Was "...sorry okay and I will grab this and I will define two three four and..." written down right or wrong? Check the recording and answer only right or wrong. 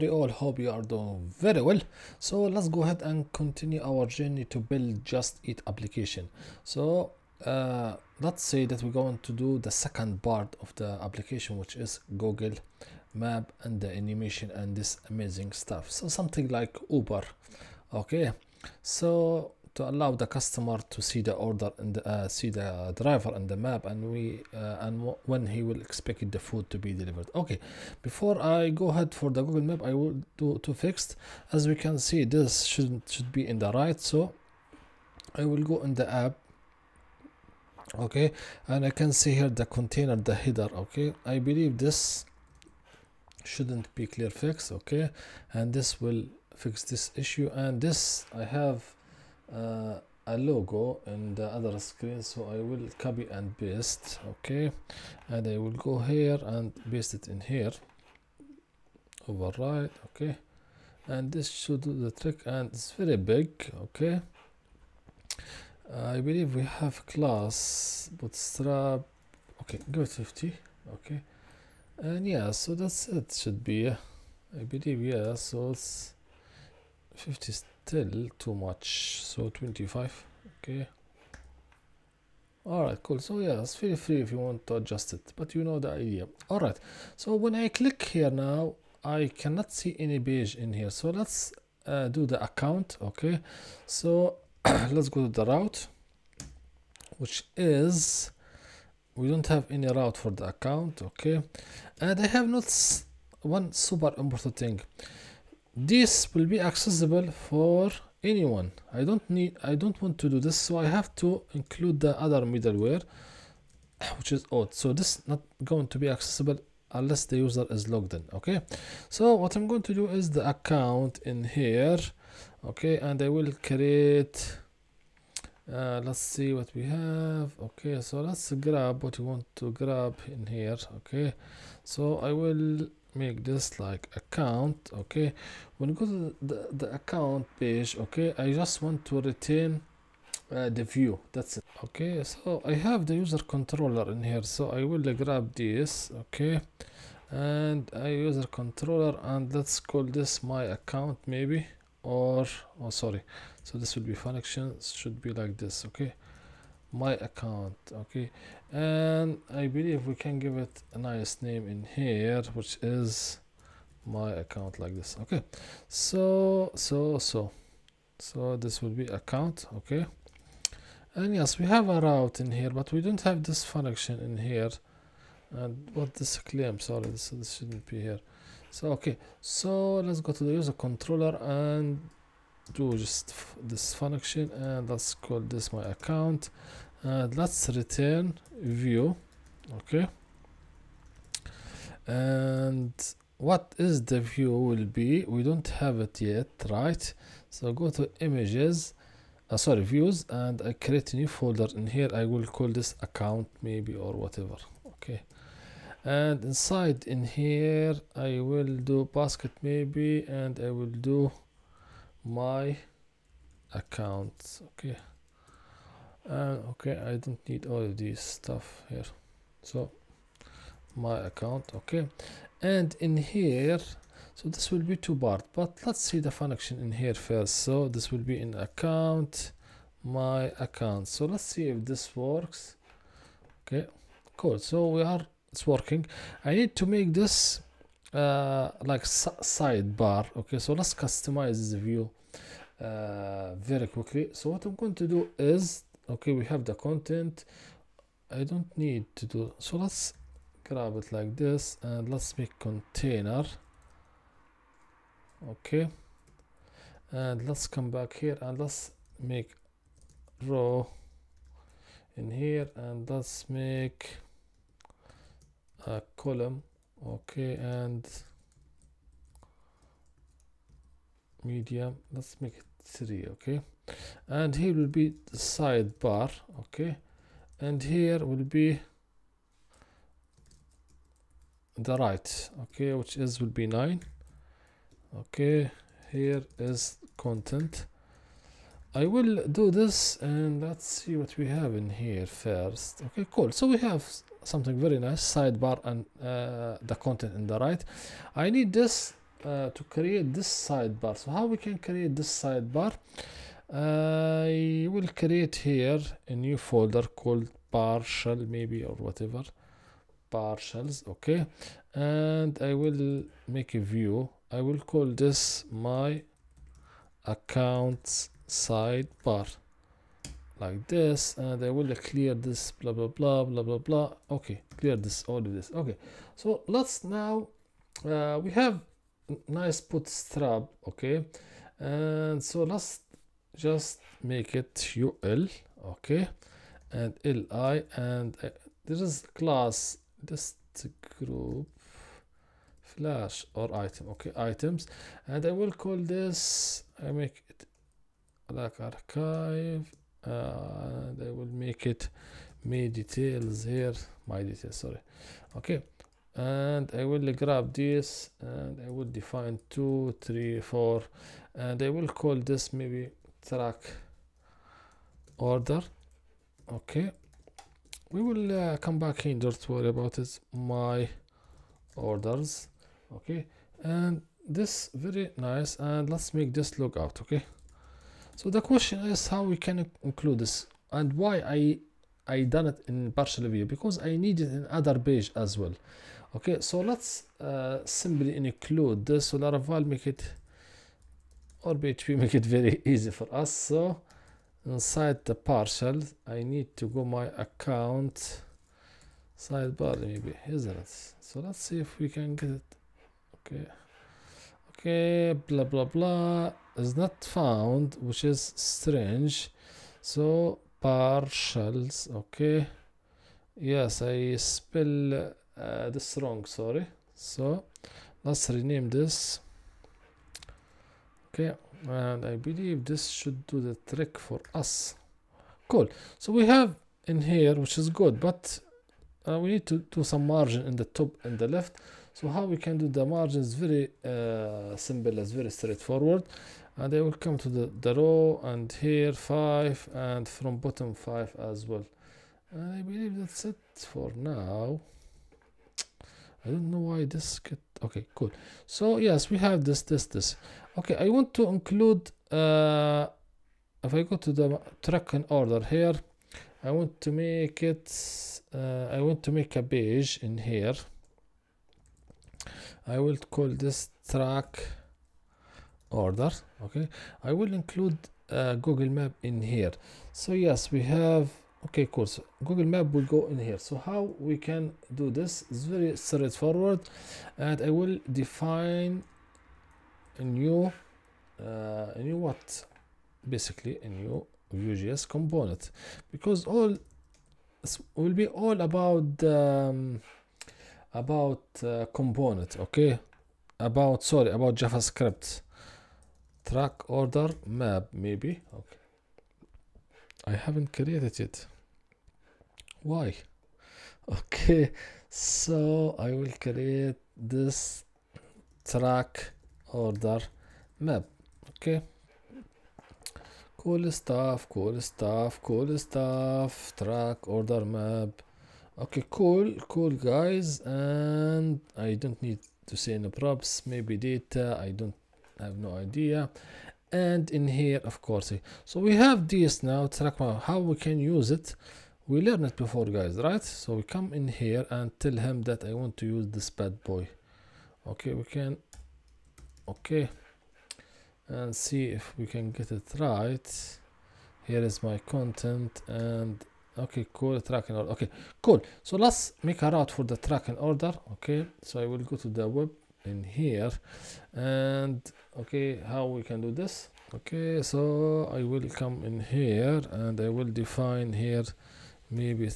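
right.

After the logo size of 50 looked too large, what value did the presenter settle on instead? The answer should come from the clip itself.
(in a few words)
25.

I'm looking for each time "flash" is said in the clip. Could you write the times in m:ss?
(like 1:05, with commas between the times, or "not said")
5:42.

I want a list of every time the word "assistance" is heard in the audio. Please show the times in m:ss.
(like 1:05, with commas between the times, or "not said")
not said.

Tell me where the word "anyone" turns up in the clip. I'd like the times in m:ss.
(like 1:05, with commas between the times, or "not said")
1:48.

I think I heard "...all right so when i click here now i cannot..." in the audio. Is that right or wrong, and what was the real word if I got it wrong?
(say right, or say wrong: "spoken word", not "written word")
right.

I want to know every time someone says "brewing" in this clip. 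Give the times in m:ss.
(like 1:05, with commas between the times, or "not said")
not said.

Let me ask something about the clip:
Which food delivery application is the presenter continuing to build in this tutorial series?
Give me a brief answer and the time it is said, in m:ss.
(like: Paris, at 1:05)
Just Eat, at 0:05.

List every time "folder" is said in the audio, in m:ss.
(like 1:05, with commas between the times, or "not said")
3:21, 5:06.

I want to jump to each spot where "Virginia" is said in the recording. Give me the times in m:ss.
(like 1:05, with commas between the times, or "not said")
not said.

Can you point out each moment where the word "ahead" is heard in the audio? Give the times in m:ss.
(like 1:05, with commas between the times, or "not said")
0:02, 0:28.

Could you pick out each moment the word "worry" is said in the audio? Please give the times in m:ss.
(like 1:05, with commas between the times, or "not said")
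6:09.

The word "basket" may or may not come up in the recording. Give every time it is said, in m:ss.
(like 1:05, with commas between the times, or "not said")
3:29.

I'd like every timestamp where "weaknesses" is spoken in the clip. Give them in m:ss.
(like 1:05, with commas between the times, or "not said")
not said.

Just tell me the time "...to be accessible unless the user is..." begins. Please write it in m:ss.
1:55.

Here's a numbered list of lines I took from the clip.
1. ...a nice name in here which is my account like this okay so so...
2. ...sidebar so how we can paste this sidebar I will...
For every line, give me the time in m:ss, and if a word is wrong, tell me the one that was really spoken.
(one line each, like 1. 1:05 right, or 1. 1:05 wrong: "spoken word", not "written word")
1. 2:40 right
2. 5:00 wrong: "create", not "paste".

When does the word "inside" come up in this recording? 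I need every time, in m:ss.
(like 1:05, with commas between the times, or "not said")
3:26, 6:34.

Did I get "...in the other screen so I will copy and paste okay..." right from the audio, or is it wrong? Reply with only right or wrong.
right.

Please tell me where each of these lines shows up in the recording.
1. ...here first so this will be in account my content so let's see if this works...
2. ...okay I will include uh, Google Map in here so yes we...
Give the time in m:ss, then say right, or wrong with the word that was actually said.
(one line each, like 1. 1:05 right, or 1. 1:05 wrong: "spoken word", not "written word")
1. 3:46 wrong: "account", not "content"
2. 7:46 right.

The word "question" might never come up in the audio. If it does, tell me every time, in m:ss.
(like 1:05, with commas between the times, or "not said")
6:18.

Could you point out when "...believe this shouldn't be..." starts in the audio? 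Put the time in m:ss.
0:41.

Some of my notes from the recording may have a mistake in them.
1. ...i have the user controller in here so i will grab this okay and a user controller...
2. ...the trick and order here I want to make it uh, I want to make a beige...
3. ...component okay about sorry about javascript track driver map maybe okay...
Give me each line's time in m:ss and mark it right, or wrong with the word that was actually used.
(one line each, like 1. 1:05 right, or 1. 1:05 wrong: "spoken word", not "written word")
1. 2:22 right
2. 7:34 wrong: "track", not "trick"
3. 8:11 wrong: "order", not "driver".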